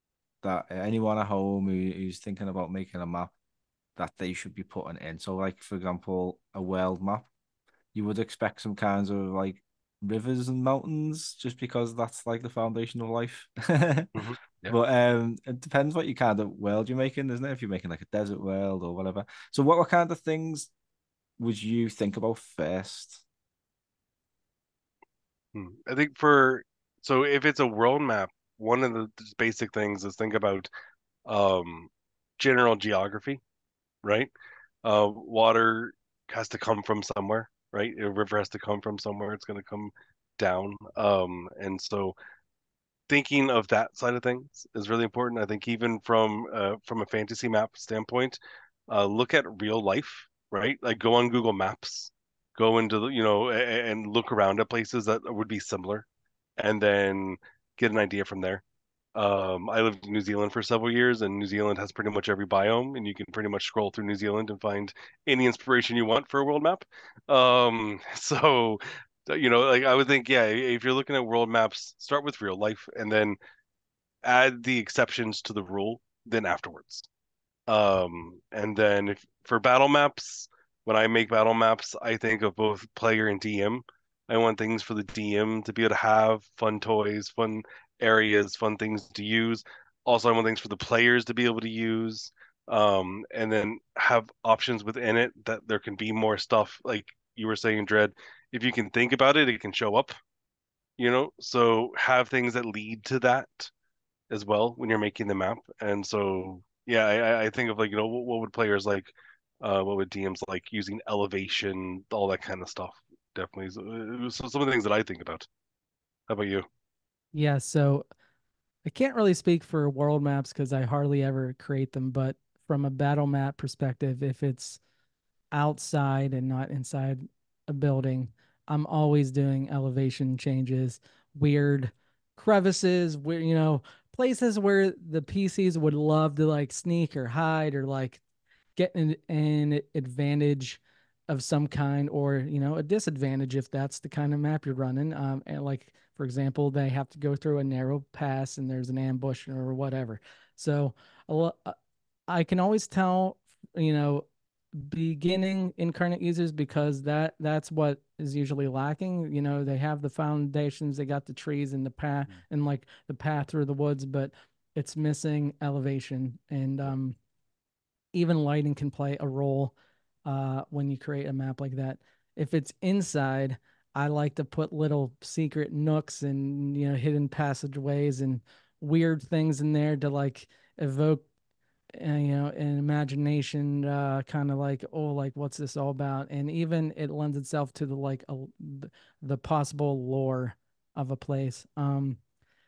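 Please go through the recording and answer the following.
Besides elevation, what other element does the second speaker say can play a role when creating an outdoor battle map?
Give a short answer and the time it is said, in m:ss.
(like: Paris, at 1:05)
Lighting, at 2:48.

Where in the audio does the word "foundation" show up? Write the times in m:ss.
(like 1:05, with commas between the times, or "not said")
0:12, 2:40.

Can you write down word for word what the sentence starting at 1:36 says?
Like you were saying, Dread, if you can think about it, it can show up.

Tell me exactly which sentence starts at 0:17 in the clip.
If you're making like a desert world or whatever.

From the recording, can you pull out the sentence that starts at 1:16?
Then afterwards, um, and then if, for battle maps, when I make battle maps, I think of both player and DM.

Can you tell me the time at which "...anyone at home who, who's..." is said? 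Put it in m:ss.
0:00.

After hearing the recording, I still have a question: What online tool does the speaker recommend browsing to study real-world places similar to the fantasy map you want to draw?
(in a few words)
Google Maps.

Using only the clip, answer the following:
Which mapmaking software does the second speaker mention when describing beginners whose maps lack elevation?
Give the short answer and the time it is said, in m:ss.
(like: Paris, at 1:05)
Inkarnate, at 2:35.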